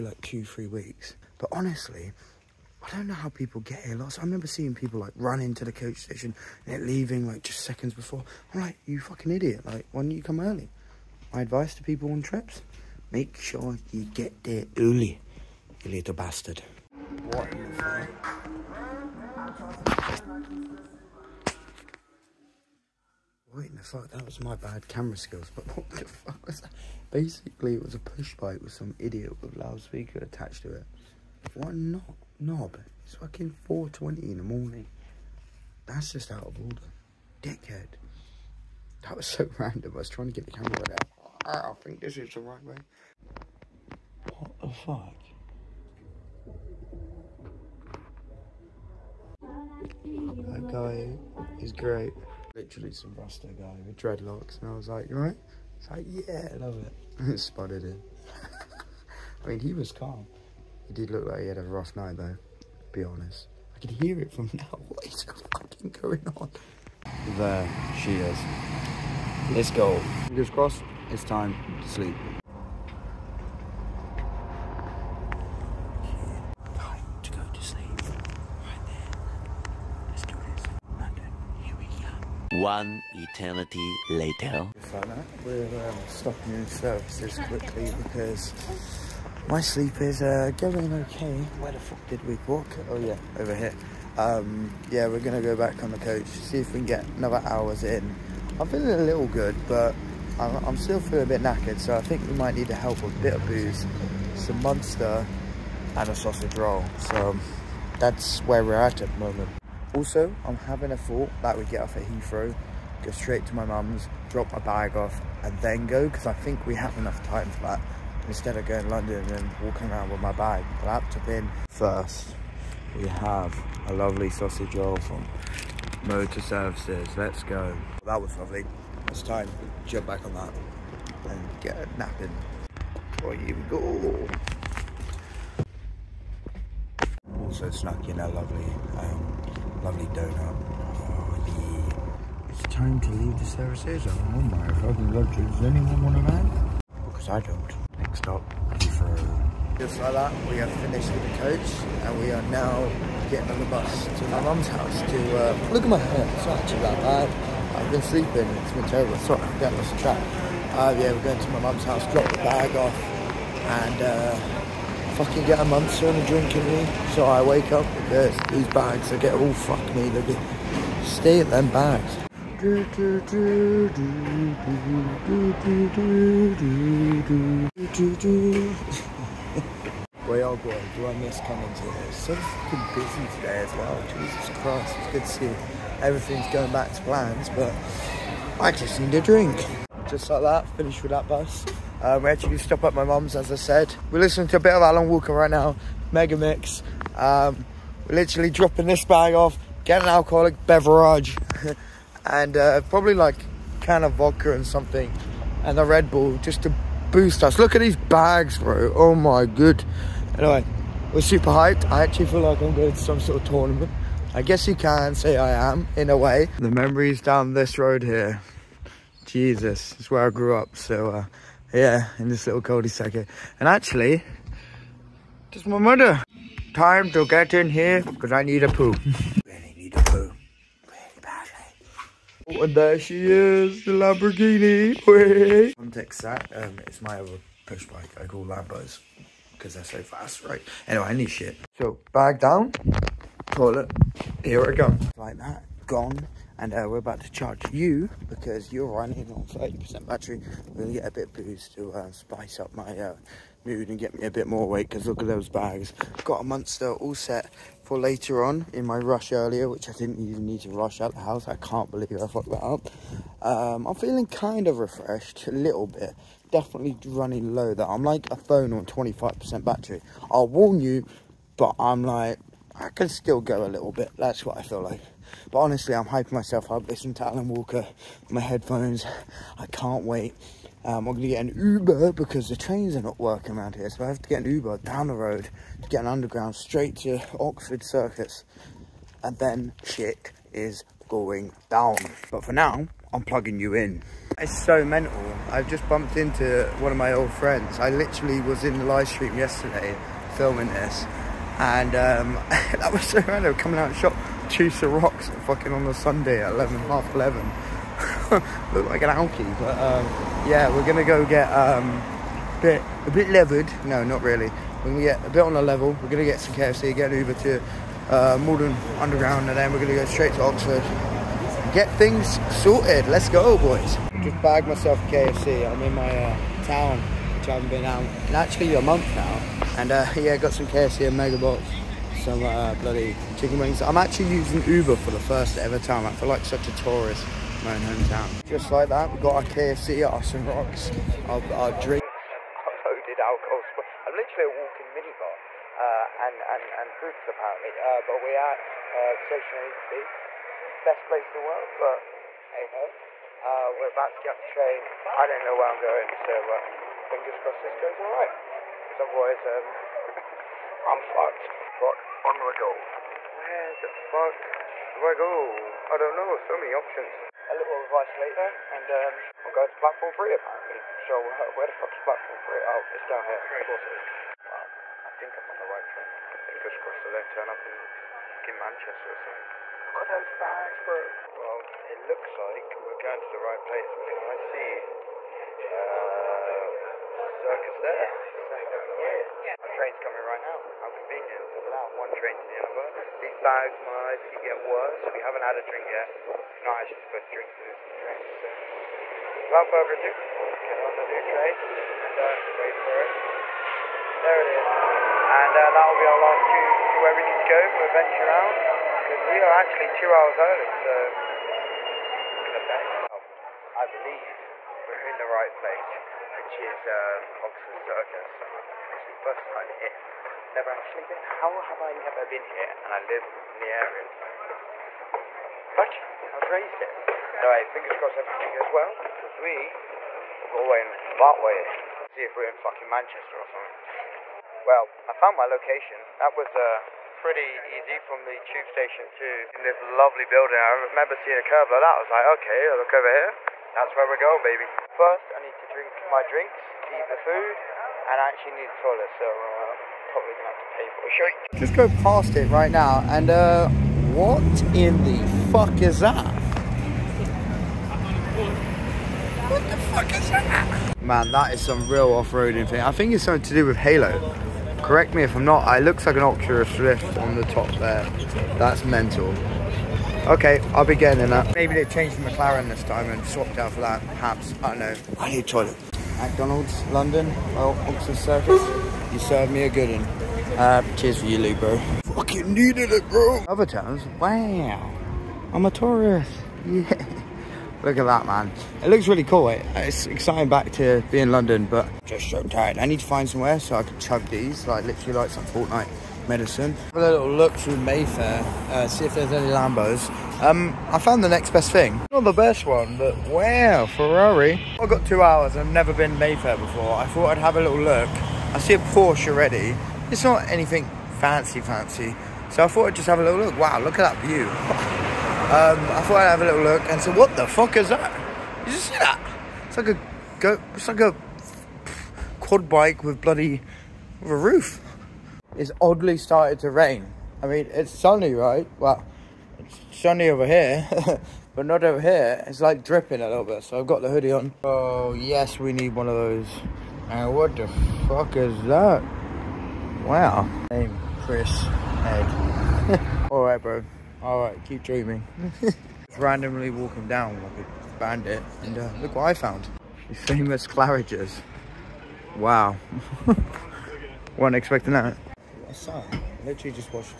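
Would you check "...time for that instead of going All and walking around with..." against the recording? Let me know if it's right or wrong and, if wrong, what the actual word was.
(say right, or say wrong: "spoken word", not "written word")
wrong: "London", not "All".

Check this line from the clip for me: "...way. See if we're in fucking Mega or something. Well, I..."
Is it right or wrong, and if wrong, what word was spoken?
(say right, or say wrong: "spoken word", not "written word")
wrong: "Manchester", not "Mega".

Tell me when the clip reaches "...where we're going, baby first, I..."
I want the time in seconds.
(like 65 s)
443 s.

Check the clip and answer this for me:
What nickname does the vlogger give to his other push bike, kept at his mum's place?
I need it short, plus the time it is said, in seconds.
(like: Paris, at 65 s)
Lamborghini, at 233 s.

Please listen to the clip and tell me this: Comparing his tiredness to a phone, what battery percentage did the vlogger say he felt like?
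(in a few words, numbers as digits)
25%.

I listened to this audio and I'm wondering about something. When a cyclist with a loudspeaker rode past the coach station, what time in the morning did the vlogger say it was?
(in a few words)
4:20.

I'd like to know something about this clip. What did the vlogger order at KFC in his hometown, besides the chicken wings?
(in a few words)
Mega Box.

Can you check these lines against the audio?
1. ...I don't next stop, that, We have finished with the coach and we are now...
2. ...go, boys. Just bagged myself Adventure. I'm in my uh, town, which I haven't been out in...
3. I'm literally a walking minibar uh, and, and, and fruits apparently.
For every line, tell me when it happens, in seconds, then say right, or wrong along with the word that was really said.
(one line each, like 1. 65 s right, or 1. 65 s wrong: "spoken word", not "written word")
1. 147 s right
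2. 323 s wrong: "KFC", not "Adventure"
3. 344 s right.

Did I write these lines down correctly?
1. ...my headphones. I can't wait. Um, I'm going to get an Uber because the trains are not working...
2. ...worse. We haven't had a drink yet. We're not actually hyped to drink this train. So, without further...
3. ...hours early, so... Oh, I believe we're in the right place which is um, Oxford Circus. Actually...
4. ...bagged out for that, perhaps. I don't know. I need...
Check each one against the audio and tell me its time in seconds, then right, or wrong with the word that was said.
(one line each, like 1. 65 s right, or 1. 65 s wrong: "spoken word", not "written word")
1. 278 s right
2. 394 s wrong: "supposed", not "hyped"
3. 410 s right
4. 473 s wrong: "swapped", not "bagged".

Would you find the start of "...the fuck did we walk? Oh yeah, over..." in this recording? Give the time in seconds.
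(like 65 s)
91 s.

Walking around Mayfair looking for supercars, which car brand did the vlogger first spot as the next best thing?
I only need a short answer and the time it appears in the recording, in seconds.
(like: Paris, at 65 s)
Ferrari, at 503 s.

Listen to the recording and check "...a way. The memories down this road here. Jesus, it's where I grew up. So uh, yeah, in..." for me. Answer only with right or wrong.
right.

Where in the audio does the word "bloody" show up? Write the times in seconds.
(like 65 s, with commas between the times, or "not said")
332 s, 523 s.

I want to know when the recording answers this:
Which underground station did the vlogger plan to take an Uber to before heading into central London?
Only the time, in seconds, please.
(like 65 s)
318 s.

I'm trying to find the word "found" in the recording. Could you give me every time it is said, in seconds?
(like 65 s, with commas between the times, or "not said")
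435 s, 500 s, 549 s.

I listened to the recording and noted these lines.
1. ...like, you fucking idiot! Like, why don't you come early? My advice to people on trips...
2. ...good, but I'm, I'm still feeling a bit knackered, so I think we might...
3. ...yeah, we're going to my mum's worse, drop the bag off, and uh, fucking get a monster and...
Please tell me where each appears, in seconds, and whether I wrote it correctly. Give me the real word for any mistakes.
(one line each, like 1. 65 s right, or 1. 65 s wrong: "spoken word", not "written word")
1. 8 s right
2. 99 s right
3. 160 s wrong: "house", not "worse".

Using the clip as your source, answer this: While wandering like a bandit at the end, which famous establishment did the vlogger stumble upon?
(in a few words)
Claridge's.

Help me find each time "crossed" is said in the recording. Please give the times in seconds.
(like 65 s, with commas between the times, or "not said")
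70 s, 357 s, 376 s, 427 s.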